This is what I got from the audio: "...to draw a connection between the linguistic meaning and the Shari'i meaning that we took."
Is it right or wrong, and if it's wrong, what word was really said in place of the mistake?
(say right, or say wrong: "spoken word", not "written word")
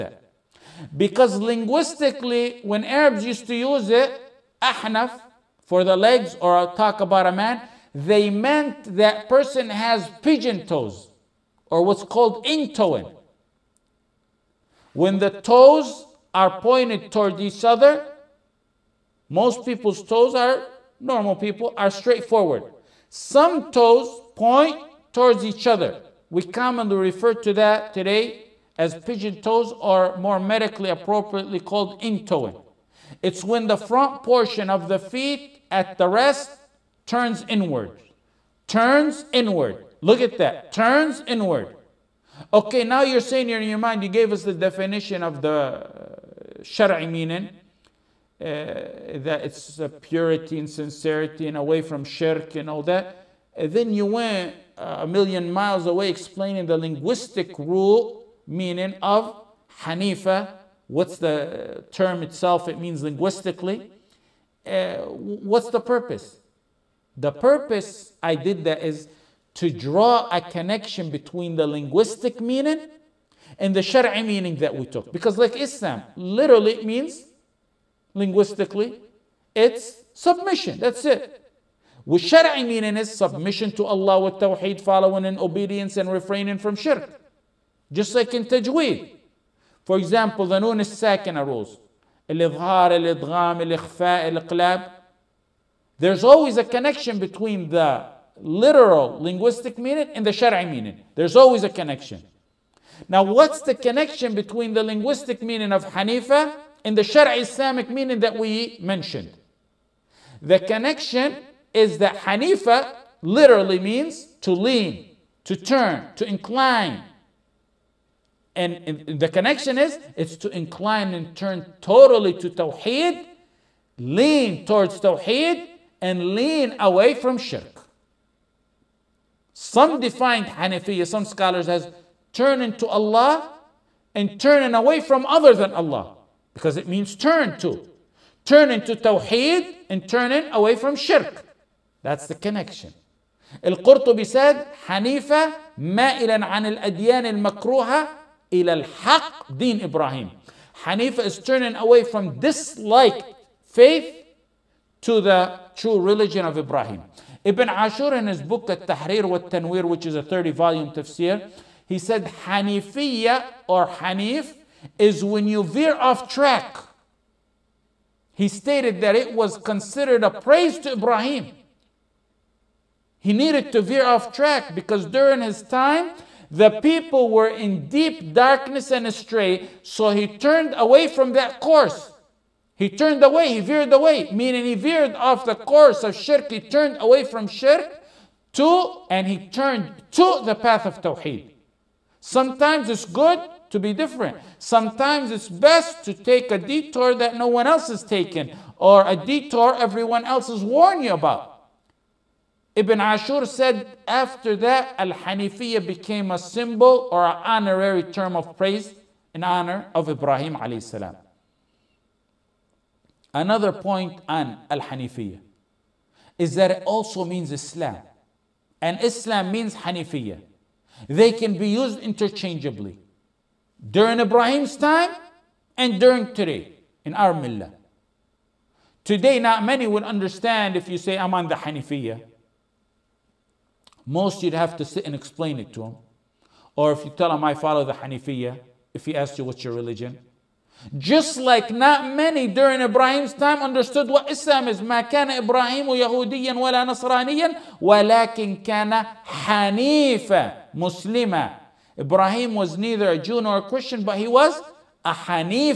right.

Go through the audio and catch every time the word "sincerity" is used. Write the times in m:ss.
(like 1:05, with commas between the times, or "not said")
0:50.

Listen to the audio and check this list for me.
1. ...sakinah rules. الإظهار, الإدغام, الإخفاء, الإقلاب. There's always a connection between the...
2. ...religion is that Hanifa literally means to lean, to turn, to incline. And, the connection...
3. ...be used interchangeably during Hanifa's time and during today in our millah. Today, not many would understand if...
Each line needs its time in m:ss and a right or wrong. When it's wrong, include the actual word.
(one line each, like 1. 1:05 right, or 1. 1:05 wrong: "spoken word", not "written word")
1. 1:30 right
2. 1:50 wrong: "connection", not "religion"
3. 3:41 wrong: "Ibrahim", not "Hanifa".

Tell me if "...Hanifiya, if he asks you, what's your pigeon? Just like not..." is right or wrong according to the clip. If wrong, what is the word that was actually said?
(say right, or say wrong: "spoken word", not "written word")
wrong: "religion", not "pigeon".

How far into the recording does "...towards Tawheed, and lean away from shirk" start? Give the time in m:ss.
2:04.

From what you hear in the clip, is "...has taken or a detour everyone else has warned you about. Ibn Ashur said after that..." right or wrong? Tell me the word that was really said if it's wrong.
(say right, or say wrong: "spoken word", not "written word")
right.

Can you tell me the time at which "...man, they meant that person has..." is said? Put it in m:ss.
0:07.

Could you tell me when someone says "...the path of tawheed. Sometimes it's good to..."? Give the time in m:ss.
3:10.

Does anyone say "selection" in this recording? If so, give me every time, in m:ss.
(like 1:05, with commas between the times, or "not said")
not said.